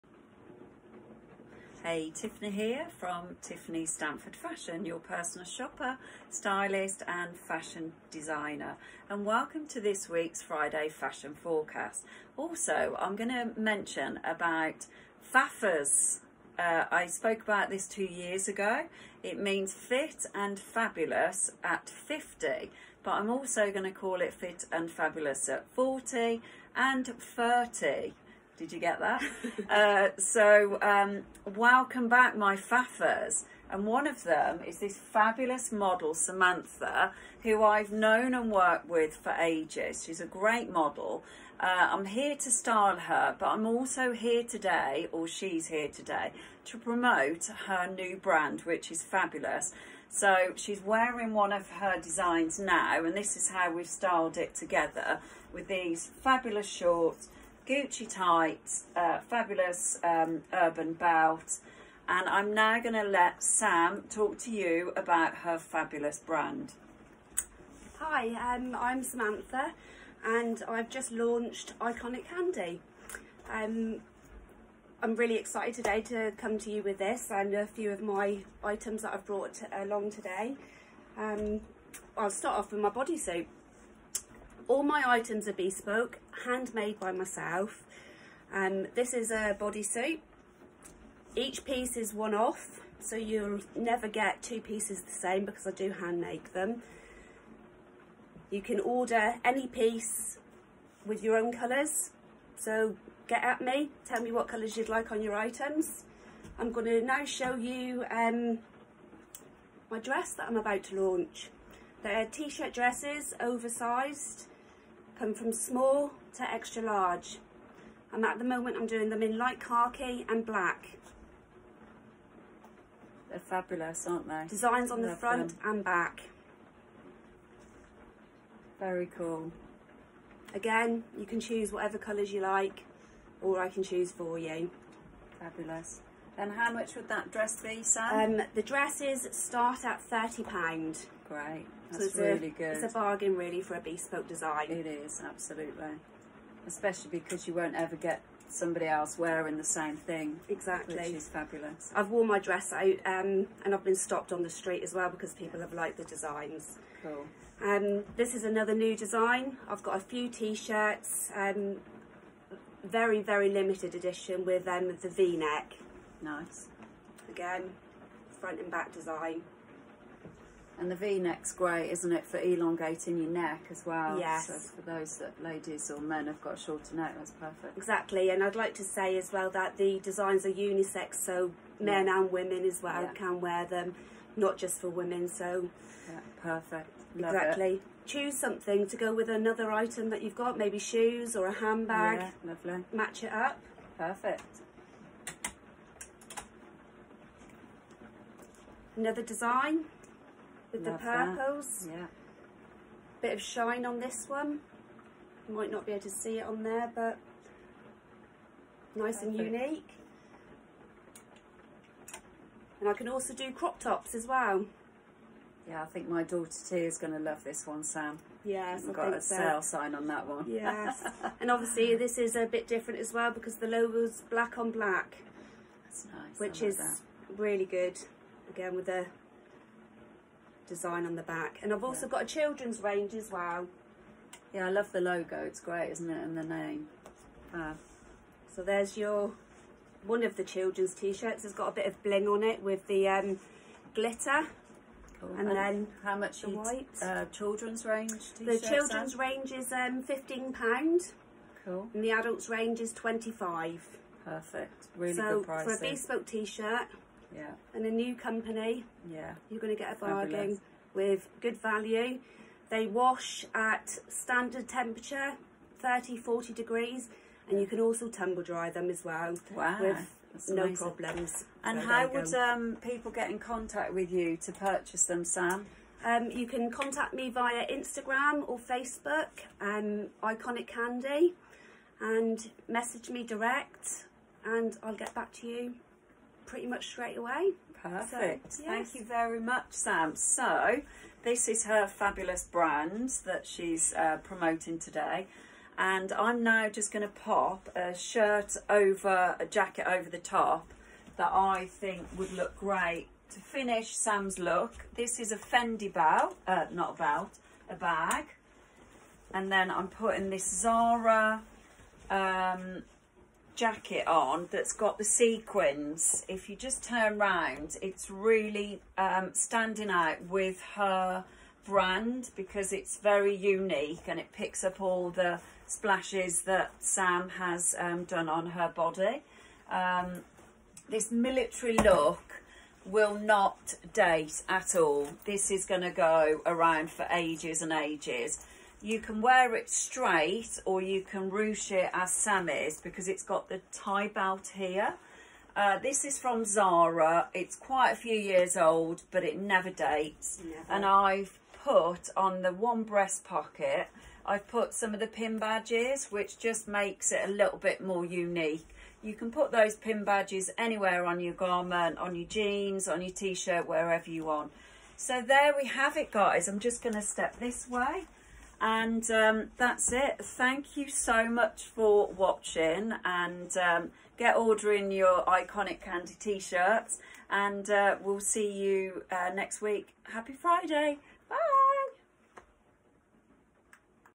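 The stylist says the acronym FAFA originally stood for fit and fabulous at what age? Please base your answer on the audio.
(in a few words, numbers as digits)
50.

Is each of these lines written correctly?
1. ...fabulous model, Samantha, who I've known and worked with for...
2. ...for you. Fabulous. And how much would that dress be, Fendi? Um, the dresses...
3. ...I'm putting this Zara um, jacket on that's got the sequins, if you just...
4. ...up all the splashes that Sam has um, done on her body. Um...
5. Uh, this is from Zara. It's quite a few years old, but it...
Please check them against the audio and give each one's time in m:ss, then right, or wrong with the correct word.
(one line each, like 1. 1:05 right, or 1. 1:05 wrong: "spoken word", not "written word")
1. 0:34 right
2. 2:14 wrong: "Sam", not "Fendi"
3. 5:09 right
4. 5:24 right
5. 5:45 right.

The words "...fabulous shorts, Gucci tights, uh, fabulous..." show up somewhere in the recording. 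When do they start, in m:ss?
0:56.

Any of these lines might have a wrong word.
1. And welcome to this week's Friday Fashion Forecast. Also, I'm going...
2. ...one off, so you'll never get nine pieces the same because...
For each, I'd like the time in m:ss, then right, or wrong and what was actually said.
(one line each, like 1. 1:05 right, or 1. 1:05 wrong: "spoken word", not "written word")
1. 0:09 right
2. 1:32 wrong: "two", not "nine".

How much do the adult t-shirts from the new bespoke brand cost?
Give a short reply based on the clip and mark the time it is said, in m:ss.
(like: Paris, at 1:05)
£25, at 4:12.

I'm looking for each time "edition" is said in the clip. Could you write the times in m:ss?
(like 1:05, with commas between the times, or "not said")
2:43.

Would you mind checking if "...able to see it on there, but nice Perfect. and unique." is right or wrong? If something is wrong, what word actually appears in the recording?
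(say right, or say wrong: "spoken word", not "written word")
right.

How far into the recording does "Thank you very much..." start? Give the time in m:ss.
4:48.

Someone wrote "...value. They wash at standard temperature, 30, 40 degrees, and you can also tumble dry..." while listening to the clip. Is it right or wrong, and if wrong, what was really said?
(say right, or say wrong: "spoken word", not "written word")
right.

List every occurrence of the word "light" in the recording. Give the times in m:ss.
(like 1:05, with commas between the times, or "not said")
1:59.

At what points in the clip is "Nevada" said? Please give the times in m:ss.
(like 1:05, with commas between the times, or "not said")
not said.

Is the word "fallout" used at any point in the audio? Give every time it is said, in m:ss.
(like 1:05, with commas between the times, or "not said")
not said.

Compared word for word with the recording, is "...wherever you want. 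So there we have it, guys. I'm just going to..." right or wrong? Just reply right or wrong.
right.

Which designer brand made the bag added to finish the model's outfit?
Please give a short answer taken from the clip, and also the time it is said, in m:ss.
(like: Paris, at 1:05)
Fendi, at 5:05.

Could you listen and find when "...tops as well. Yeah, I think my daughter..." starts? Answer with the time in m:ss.
3:33.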